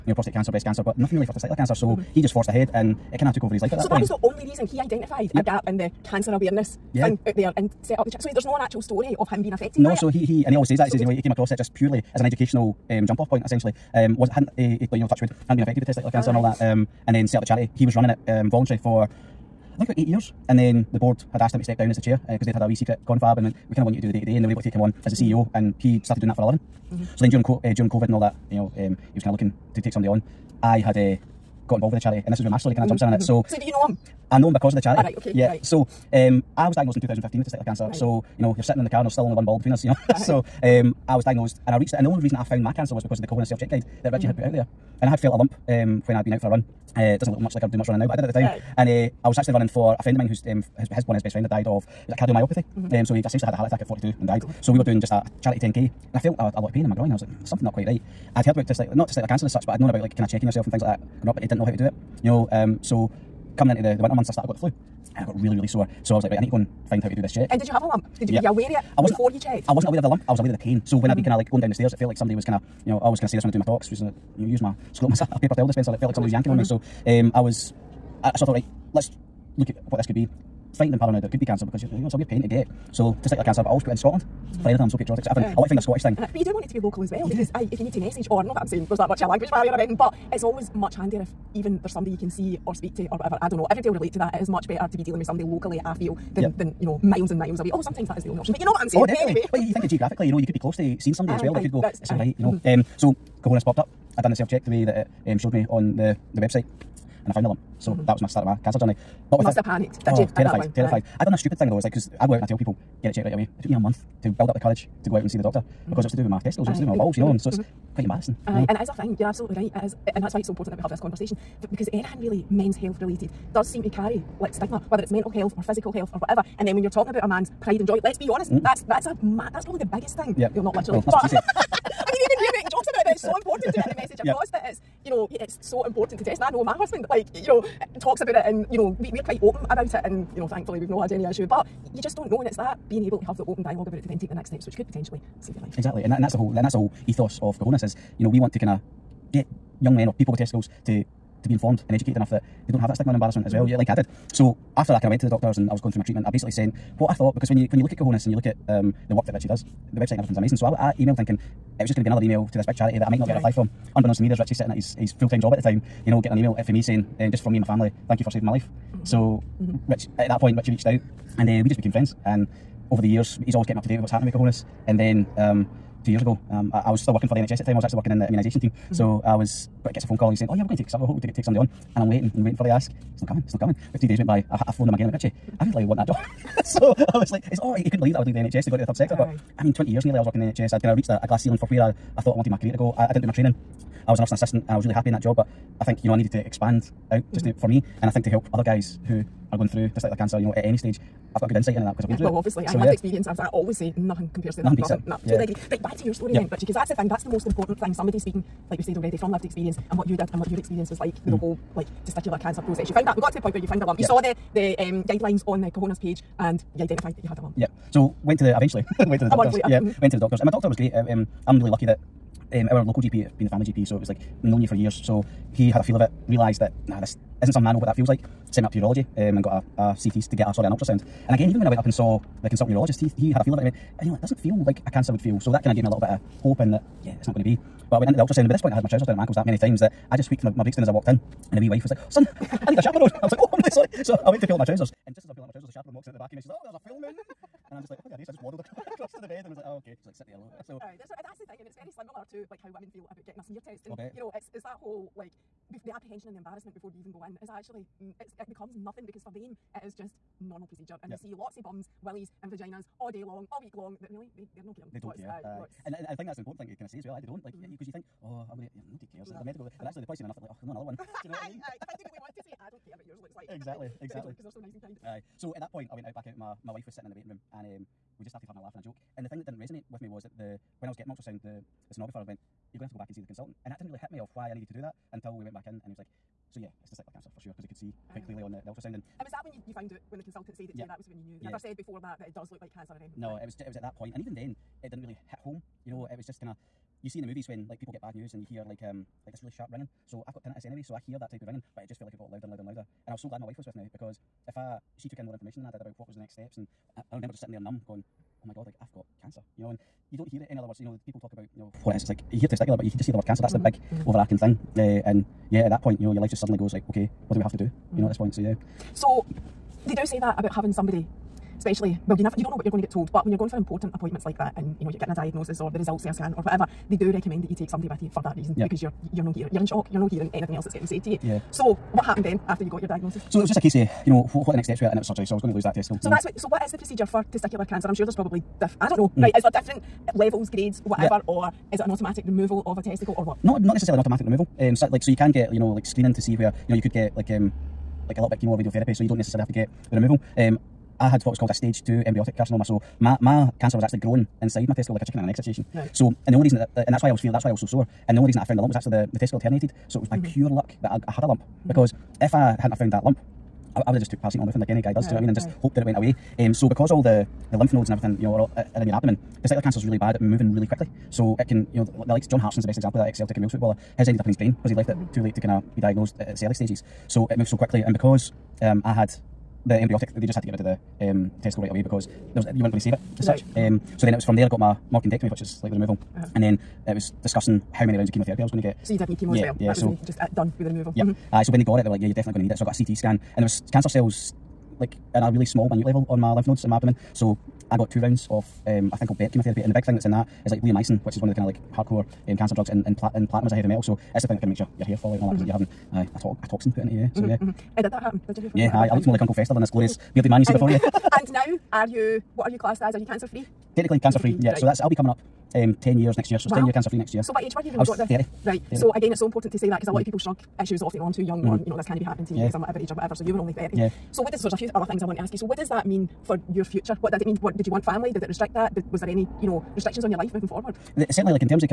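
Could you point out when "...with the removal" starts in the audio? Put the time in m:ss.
6:30.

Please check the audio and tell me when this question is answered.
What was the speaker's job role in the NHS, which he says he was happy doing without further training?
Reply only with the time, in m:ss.
3:14.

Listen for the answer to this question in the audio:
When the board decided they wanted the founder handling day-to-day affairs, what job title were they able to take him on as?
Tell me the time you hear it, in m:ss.
0:25.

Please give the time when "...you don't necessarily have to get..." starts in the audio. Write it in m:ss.
5:49.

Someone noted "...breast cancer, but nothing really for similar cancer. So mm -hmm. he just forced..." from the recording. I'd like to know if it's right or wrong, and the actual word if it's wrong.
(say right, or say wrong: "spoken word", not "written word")
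wrong: "testicular", not "similar".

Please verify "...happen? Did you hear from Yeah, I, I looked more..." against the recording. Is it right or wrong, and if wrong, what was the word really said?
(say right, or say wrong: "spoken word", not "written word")
right.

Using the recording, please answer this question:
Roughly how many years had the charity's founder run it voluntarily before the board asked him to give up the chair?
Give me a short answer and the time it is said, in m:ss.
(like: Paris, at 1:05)
8 years, at 0:19.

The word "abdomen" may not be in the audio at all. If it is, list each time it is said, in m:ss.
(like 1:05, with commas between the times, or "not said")
6:08, 6:36.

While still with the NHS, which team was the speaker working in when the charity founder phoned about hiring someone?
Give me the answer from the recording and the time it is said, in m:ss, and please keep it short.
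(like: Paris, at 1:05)
Immunisation team, at 2:58.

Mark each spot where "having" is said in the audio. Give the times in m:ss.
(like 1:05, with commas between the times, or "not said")
4:38, 5:20, 6:45.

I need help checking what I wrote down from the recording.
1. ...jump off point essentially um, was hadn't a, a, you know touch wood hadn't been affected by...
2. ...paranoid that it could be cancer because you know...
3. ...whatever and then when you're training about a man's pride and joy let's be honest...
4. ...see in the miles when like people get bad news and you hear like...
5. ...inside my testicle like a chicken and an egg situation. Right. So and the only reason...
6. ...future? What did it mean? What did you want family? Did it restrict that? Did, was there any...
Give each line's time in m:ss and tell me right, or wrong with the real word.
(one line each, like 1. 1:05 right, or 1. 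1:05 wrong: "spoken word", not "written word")
1. 0:13 right
2. 1:21 right
3. 2:06 wrong: "talking", not "training"
4. 4:57 wrong: "movies", not "miles"
5. 5:54 right
6. 7:06 right.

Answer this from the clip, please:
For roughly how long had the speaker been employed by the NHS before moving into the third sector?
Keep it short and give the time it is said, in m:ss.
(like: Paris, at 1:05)
20 years, at 3:09.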